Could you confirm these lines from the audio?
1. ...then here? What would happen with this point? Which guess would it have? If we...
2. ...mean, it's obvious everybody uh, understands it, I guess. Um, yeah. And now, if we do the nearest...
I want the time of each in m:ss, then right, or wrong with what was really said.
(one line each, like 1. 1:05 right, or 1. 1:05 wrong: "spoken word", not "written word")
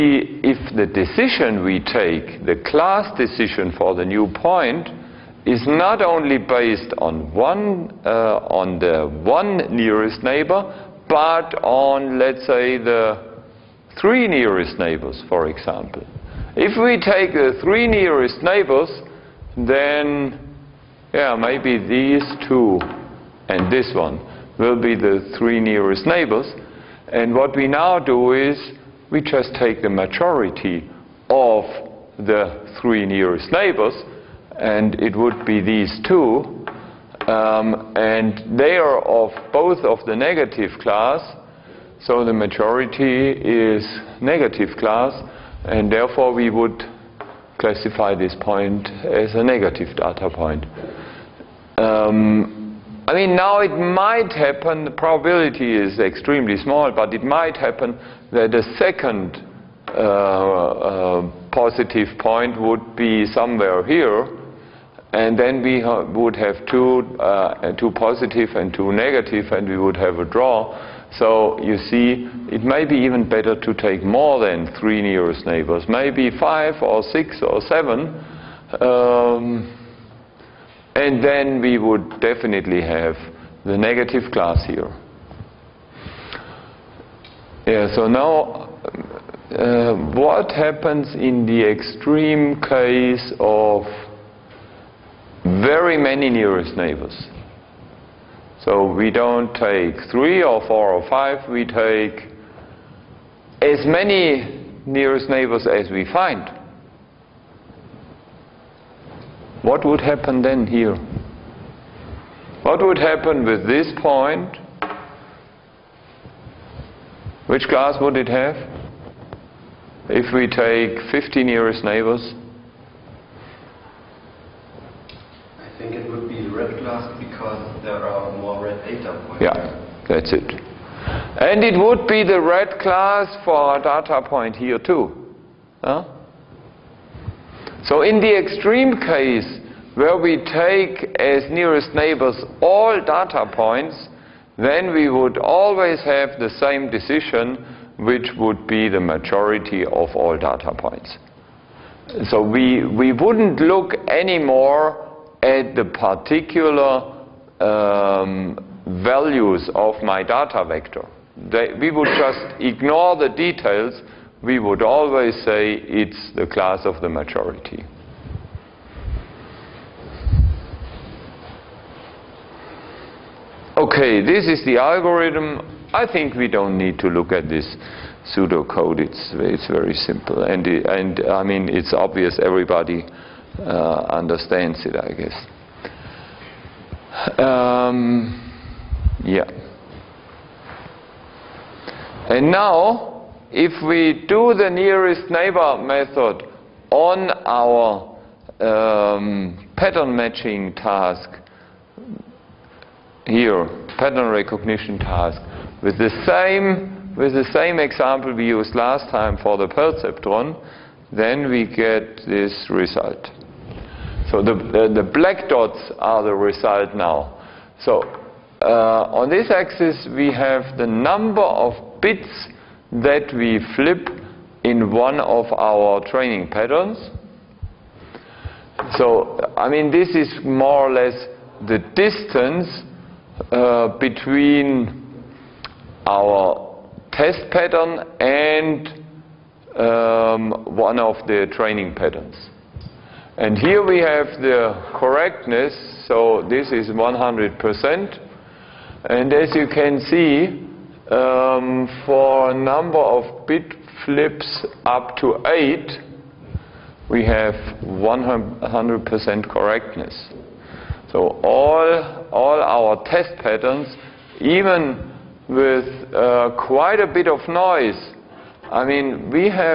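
1. 1:50 wrong: "class", not "guess"
2. 3:01 right.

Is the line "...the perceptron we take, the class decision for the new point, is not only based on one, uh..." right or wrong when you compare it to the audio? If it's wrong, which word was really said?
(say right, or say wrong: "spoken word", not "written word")
wrong: "decision", not "perceptron".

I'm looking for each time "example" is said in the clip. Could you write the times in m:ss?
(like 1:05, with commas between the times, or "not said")
0:15, 3:27.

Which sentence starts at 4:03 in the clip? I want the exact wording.
And here we have the correctness, so this is 100%.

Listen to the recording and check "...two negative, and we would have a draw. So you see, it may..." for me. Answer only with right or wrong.
right.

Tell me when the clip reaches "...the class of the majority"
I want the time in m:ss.
2:46.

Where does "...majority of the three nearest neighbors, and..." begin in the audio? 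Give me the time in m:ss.
0:29.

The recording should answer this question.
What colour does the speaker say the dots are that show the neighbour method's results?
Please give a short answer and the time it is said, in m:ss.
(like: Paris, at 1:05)
black, at 3:35.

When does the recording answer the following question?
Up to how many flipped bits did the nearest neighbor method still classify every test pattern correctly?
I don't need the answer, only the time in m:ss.
4:15.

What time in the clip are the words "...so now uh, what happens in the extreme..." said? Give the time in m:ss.
1:27.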